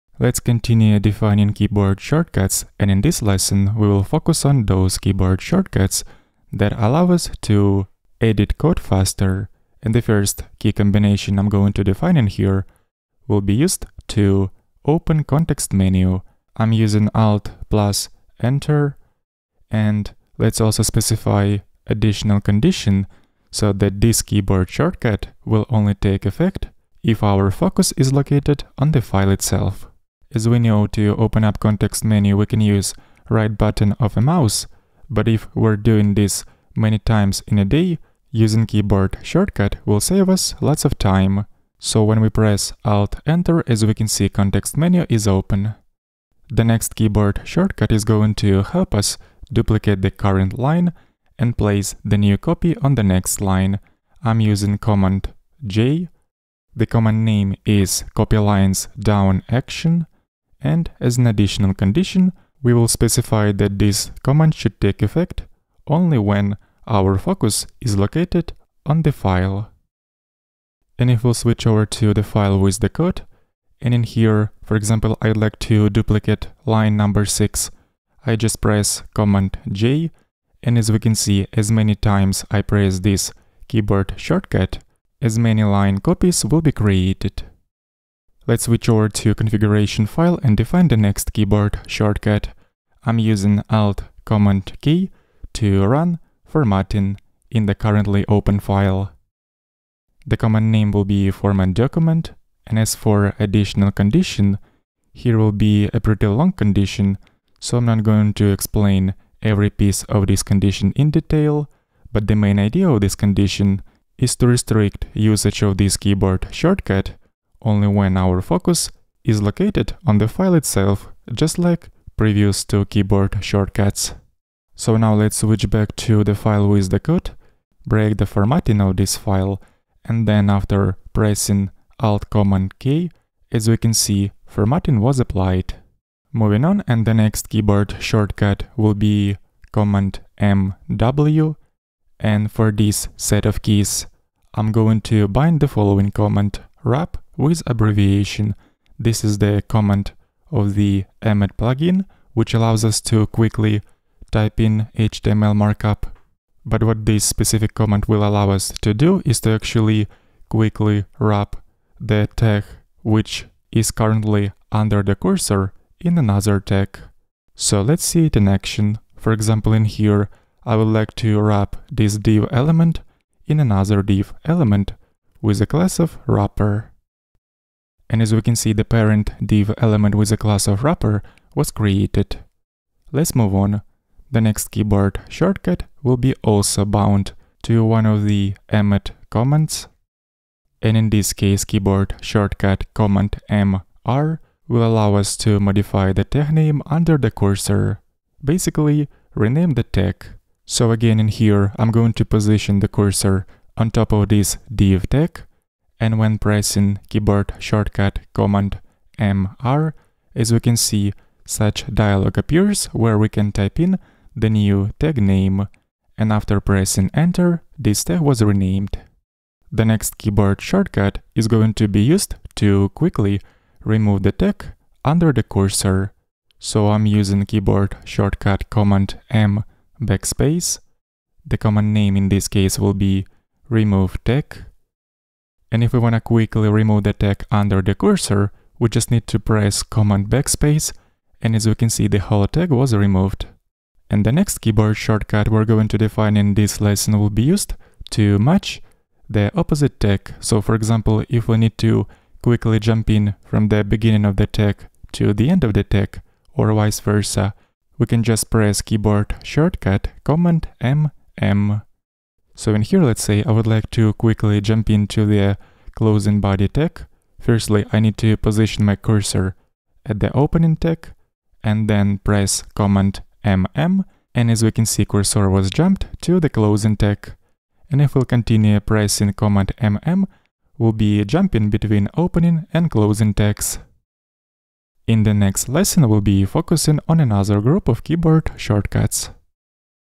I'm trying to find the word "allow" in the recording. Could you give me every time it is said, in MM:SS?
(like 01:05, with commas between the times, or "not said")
00:06, 02:32, 02:38, 03:14.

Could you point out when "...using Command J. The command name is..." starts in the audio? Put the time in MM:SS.
00:54.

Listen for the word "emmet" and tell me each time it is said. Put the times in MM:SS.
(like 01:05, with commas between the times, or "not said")
02:31, 03:08.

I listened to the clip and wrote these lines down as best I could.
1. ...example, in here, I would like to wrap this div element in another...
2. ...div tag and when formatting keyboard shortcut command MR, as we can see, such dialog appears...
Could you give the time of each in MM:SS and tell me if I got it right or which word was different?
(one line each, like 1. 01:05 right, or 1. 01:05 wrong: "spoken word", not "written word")
1. 02:49 right
2. 03:24 wrong: "pressing", not "formatting".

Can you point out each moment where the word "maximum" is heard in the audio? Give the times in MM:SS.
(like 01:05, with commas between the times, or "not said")
not said.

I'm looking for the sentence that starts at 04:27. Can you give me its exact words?
Firstly, I need to position my cursor at the opening tag and then press Command MM.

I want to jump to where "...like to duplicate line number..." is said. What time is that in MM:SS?
01:15.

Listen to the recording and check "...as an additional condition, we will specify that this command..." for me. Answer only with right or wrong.
right.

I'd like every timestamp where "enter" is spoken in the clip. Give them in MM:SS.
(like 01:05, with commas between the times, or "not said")
00:18, 00:43, 03:37.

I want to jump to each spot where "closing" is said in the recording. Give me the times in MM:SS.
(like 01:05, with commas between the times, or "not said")
04:25, 04:36, 04:42.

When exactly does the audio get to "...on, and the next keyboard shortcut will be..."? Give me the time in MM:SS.
02:16.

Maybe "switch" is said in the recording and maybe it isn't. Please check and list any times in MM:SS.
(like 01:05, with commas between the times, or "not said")
01:11, 01:28, 02:05.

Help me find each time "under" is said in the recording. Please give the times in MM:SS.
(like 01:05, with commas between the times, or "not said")
02:44, 03:16, 03:45, 03:57.